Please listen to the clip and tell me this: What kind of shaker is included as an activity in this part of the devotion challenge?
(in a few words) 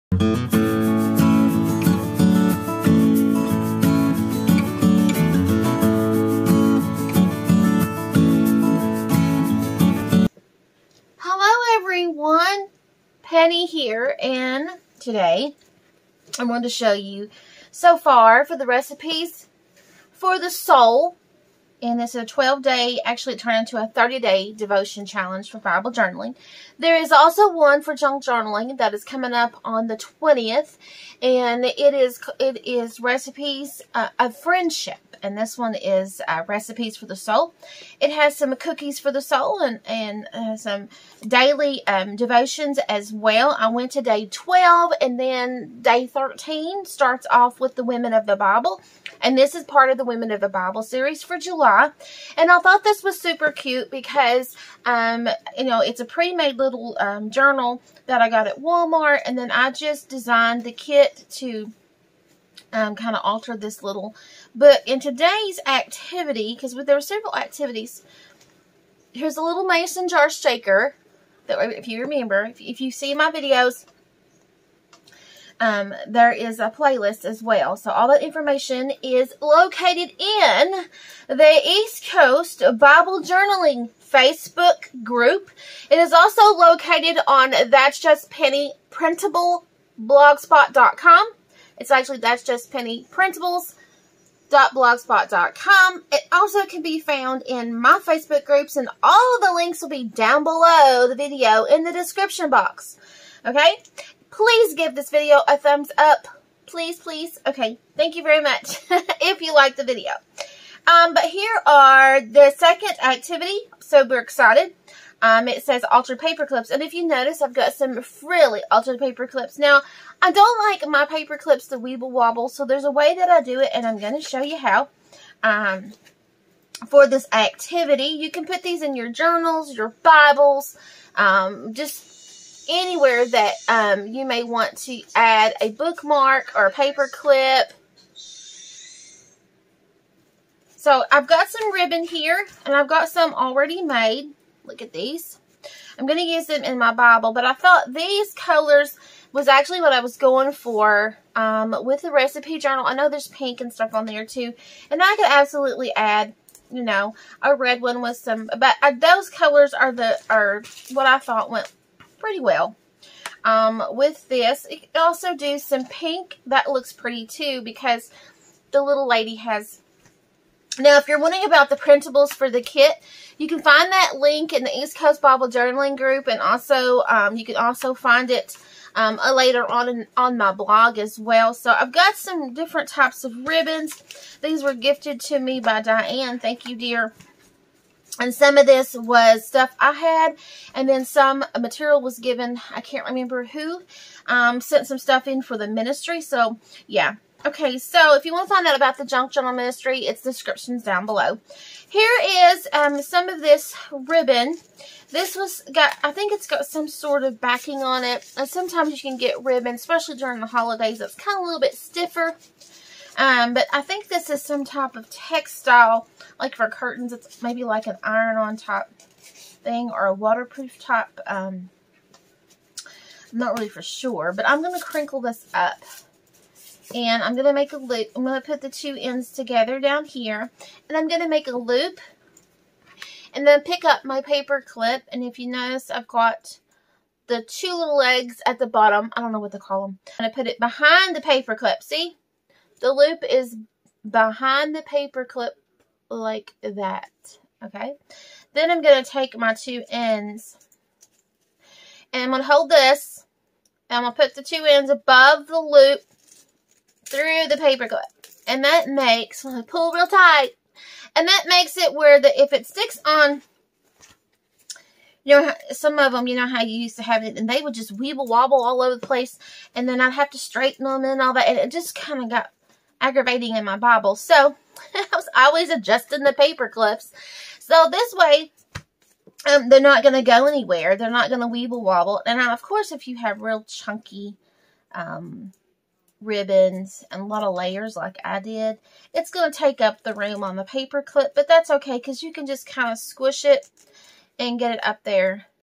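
mason jar.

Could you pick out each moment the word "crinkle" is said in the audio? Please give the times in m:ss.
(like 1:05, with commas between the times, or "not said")
3:44.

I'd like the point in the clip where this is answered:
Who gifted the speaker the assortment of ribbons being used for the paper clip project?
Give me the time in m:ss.
3:05.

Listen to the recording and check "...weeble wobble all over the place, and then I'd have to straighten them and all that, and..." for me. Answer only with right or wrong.
right.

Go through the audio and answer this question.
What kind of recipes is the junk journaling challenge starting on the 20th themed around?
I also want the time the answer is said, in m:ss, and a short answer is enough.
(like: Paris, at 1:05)
friendship, at 0:34.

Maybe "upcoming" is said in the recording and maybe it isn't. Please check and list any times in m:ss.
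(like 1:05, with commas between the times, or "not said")
not said.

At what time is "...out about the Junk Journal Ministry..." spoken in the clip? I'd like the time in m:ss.
3:18.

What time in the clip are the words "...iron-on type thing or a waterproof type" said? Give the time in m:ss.
3:38.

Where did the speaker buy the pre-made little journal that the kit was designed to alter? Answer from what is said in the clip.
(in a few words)
Walmart.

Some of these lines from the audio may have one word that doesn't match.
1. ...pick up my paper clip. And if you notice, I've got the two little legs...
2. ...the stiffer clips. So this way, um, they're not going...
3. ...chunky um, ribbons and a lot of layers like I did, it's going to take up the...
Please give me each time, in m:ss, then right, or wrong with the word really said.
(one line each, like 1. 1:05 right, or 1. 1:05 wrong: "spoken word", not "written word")
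1. 3:53 right
2. 4:36 wrong: "paper", not "stiffer"
3. 4:43 right.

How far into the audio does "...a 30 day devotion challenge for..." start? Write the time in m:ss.
0:23.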